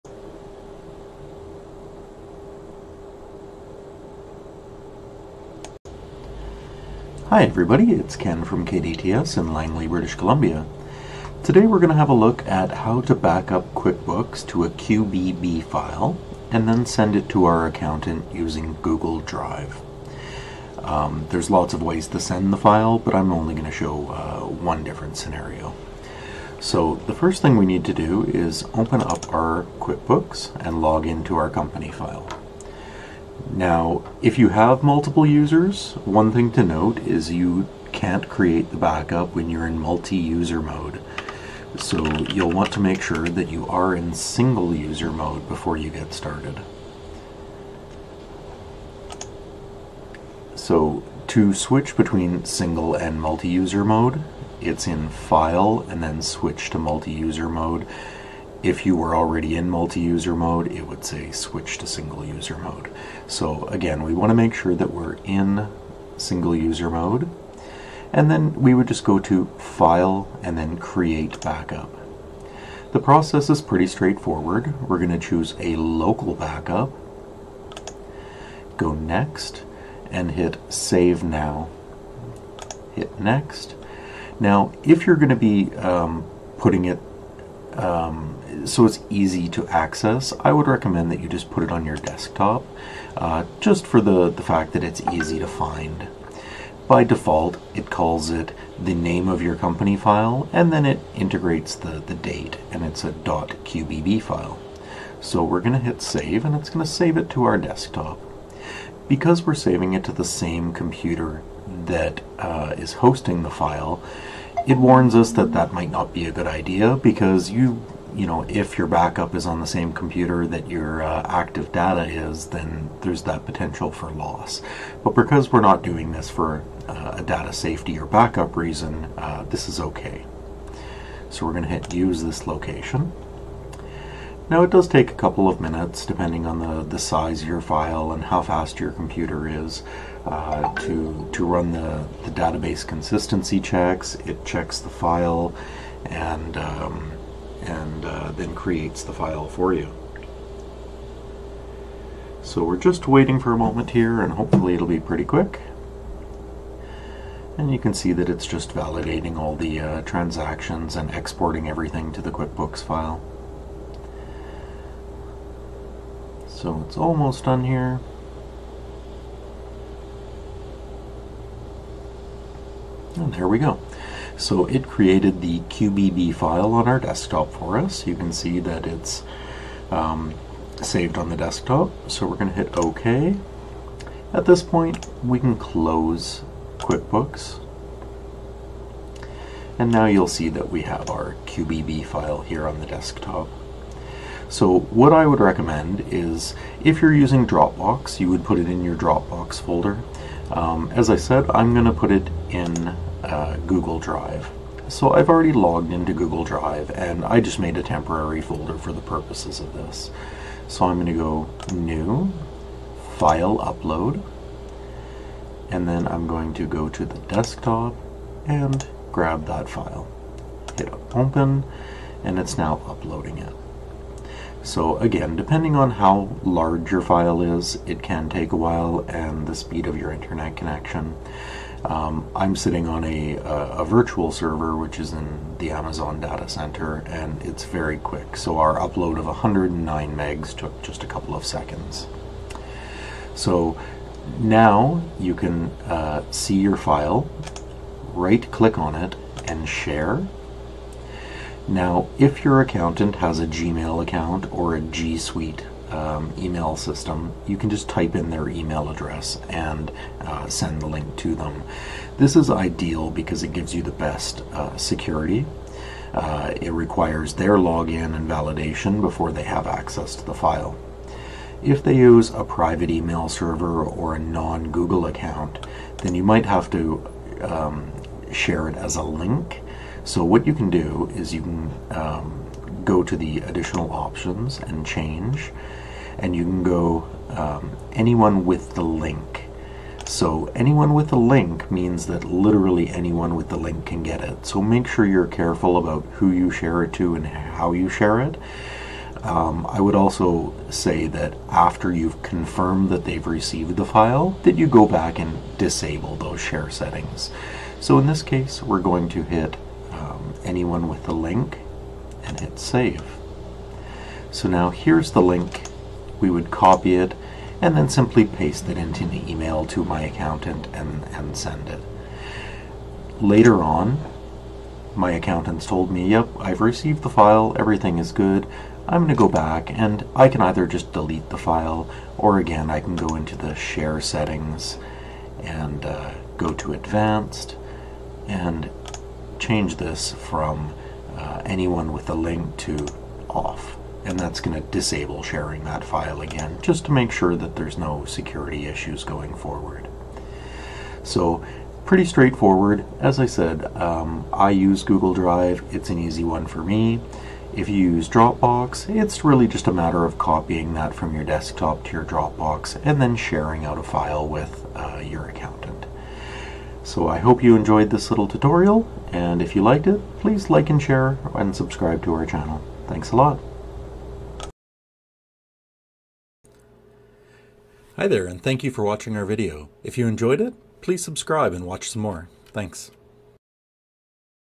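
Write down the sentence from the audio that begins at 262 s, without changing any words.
This is ideal because it gives you the best uh, security.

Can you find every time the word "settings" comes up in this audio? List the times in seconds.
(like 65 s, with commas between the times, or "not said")
306 s, 334 s.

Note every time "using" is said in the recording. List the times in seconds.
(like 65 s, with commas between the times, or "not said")
18 s, 197 s.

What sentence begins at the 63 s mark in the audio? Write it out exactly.
So again, we want to make sure that we're in single user mode.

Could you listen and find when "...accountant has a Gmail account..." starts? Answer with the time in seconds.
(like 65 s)
252 s.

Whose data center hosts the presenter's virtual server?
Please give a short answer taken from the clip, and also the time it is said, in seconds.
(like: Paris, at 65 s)
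Amazon, at 235 s.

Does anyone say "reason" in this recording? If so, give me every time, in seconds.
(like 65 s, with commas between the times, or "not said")
128 s.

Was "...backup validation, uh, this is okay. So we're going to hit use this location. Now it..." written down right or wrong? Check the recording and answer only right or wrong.
wrong.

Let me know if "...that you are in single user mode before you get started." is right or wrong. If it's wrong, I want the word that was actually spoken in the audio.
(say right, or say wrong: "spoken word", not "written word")
right.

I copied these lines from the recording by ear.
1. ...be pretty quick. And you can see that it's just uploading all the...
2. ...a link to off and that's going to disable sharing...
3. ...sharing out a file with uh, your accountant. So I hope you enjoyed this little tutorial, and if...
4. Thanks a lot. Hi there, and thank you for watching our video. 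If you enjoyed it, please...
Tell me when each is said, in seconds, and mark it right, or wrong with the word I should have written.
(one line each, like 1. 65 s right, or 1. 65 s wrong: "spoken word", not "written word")
1. 154 s wrong: "validating", not "uploading"
2. 342 s right
3. 363 s right
4. 372 s right.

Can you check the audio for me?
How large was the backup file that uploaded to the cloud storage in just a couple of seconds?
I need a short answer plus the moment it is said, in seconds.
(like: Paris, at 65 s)
109 megs, at 239 s.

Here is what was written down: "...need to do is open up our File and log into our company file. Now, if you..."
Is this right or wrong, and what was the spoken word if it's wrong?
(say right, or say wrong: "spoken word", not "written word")
wrong: "QuickBooks", not "File".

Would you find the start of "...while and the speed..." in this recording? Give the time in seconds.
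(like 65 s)
228 s.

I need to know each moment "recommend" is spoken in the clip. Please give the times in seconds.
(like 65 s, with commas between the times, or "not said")
90 s, 195 s.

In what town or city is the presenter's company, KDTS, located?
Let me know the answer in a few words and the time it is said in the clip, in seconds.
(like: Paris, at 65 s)
Langley, at 9 s.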